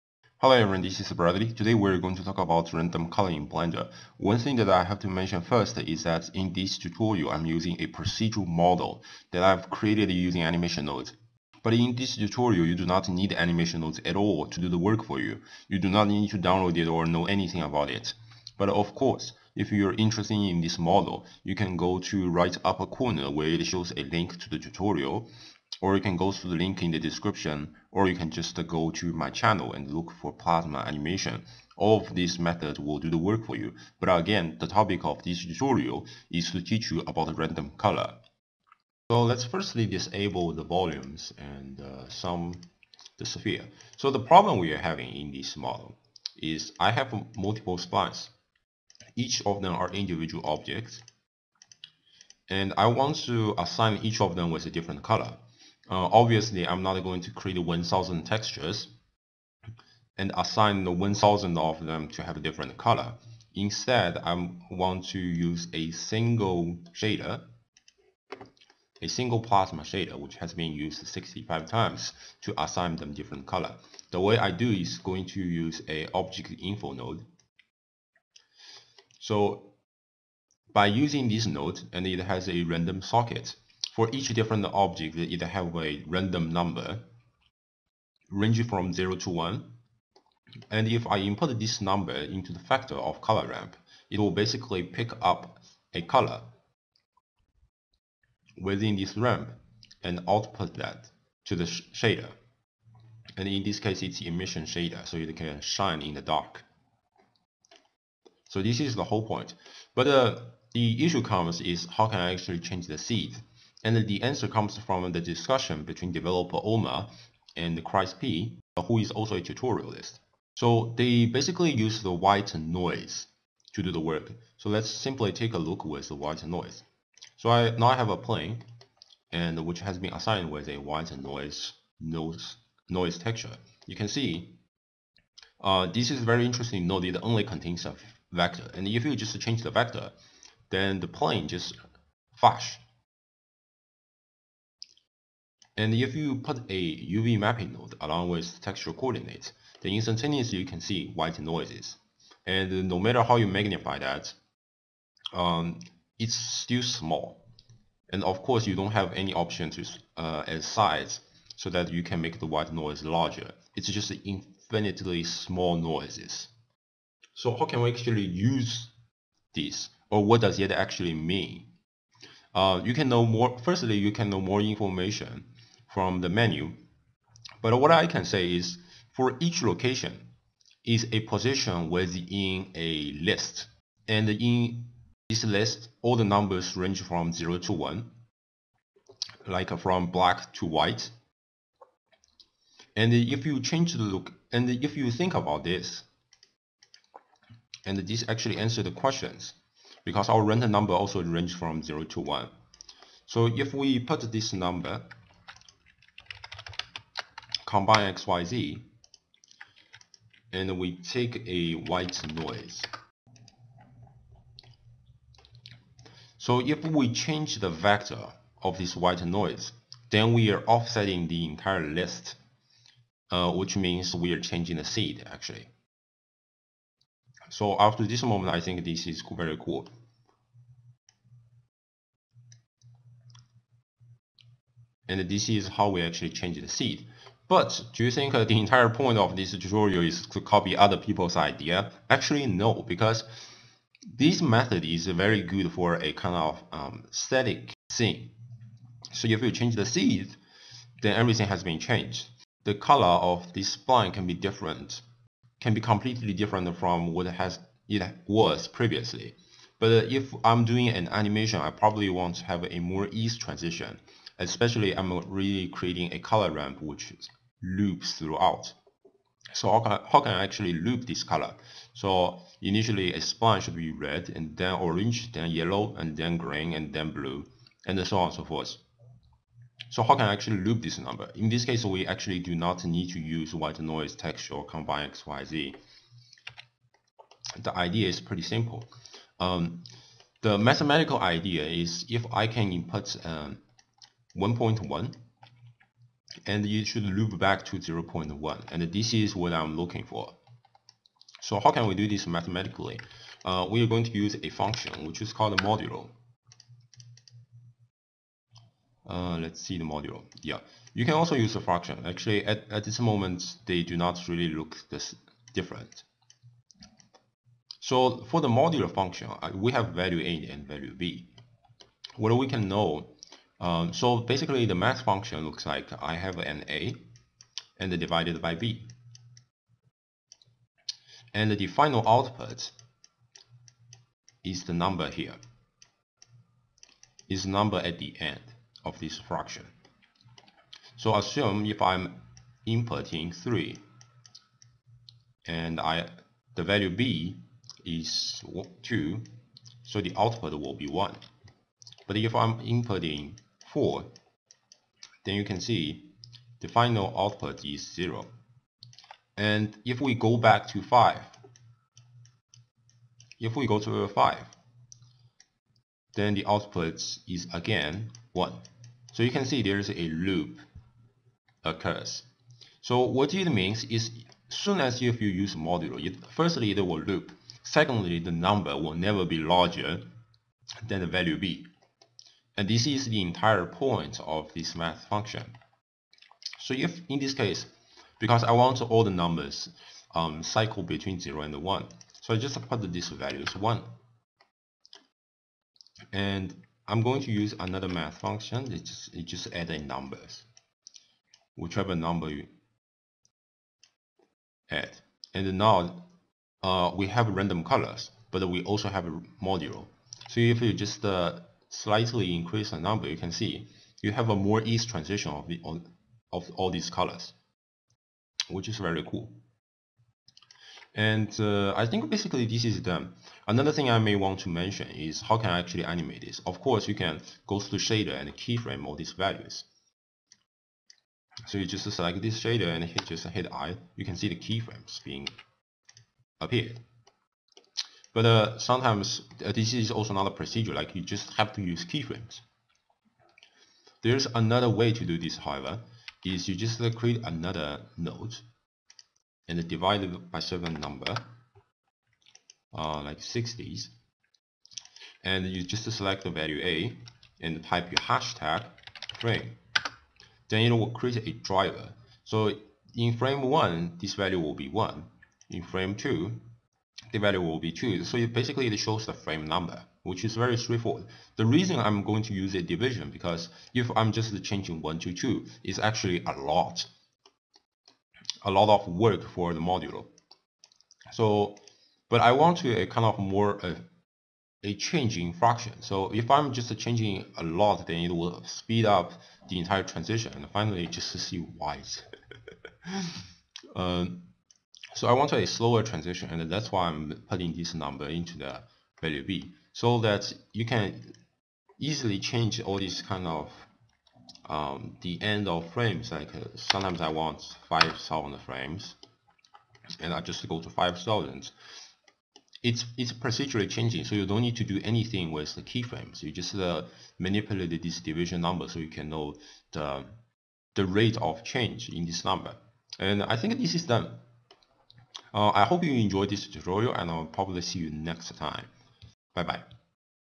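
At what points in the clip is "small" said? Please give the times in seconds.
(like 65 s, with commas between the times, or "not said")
156 s, 165 s.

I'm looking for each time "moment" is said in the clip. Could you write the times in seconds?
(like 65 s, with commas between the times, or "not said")
228 s, 312 s.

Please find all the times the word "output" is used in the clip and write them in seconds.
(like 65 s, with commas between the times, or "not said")
100 s, 332 s, 350 s, 357 s, 366 s.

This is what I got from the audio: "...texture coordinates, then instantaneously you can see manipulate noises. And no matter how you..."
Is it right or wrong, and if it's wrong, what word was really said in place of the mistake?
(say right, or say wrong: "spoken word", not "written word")
wrong: "white", not "manipulate".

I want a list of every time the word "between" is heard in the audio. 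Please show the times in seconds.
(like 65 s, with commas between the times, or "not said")
115 s, 390 s.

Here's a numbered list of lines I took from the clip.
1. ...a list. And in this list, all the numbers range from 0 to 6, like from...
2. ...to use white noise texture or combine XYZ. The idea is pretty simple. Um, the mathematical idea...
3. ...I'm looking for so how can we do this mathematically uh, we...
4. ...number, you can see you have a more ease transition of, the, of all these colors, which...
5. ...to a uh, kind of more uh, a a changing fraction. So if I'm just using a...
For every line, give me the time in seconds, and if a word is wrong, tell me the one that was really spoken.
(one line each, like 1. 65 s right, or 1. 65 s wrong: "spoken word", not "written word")
1. 182 s wrong: "1", not "6"
2. 283 s right
3. 299 s right
4. 412 s right
5. 482 s wrong: "changing", not "using".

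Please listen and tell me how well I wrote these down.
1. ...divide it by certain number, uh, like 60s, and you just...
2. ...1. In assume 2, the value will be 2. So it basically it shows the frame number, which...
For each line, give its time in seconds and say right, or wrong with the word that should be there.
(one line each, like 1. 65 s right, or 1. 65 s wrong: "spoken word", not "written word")
1. 449 s right
2. 464 s wrong: "frame", not "assume".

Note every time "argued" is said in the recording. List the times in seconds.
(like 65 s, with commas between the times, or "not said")
not said.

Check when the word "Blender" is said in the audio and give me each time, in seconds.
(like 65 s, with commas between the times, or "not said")
3 s.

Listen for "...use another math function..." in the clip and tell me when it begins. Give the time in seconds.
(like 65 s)
397 s.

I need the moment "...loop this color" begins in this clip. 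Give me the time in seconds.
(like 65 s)
270 s.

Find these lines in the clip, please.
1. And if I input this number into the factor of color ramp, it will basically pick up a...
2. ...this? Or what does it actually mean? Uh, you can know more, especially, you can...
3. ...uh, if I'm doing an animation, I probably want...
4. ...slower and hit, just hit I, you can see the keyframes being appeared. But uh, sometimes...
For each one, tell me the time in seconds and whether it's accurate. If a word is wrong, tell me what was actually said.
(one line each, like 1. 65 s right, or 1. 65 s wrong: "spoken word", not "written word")
1. 90 s right
2. 169 s wrong: "firstly", not "especially"
3. 259 s right
4. 432 s wrong: "shader", not "slower".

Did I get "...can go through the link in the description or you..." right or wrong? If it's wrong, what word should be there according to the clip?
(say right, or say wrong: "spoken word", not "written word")
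right.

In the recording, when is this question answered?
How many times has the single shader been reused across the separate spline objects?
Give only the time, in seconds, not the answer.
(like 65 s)
71 s.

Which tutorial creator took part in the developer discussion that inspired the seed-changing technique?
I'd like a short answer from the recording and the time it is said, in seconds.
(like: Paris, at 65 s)
Chris P, at 117 s.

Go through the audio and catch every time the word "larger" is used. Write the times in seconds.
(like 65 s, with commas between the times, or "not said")
163 s, 379 s.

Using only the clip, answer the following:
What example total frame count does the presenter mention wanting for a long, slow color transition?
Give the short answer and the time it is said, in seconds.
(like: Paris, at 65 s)
5,000, at 507 s.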